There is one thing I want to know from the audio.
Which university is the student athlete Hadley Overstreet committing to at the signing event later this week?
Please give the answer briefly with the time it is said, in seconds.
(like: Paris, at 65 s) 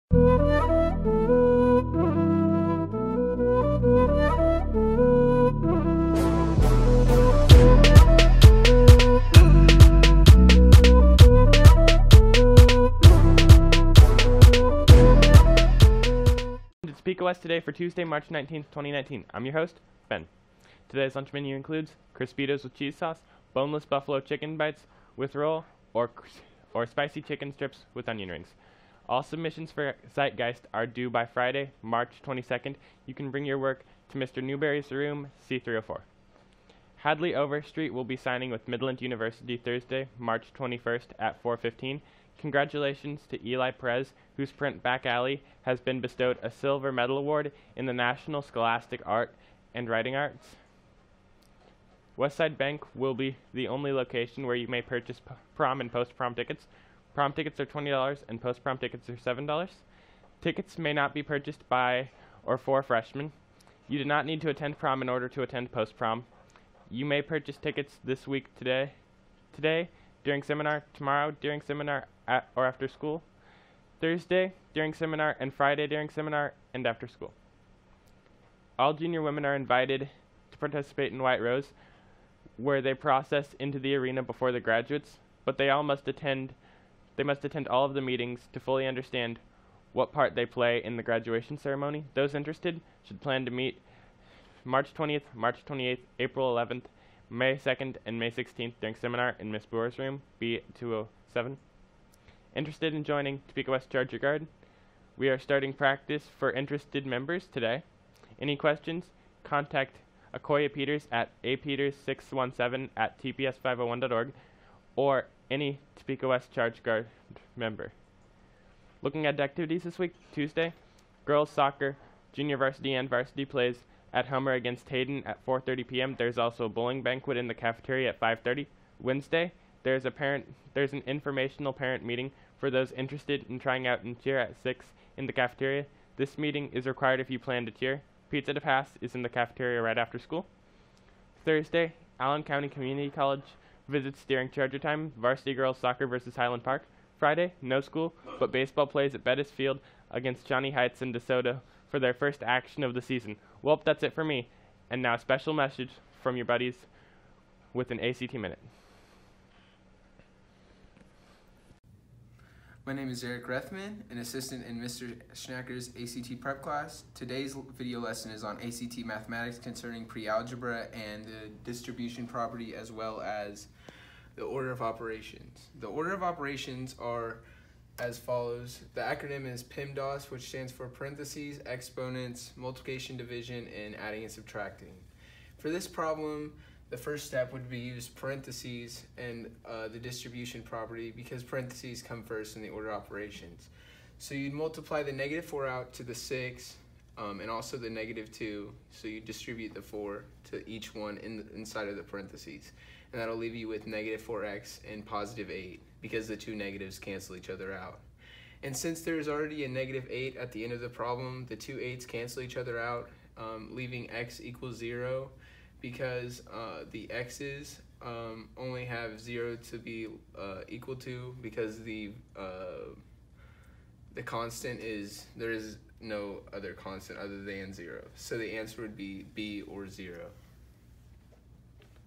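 Midland University, at 38 s.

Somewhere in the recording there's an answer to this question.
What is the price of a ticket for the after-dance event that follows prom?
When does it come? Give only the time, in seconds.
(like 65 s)
59 s.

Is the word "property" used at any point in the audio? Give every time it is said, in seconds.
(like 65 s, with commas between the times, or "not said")
172 s, 190 s.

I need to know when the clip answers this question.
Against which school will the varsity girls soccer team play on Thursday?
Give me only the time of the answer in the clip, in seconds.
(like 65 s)
146 s.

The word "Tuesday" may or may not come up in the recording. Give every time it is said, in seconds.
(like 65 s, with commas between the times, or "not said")
17 s, 120 s.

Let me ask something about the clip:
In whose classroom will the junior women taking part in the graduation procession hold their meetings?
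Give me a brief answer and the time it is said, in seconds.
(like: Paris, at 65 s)
Miss Brewer's, at 99 s.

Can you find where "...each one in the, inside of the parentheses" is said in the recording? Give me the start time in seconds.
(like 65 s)
200 s.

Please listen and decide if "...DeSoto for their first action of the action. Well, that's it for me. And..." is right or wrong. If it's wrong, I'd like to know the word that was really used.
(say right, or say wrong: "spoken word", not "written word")
wrong: "season", not "action".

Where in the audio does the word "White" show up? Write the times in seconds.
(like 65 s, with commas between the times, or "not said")
81 s.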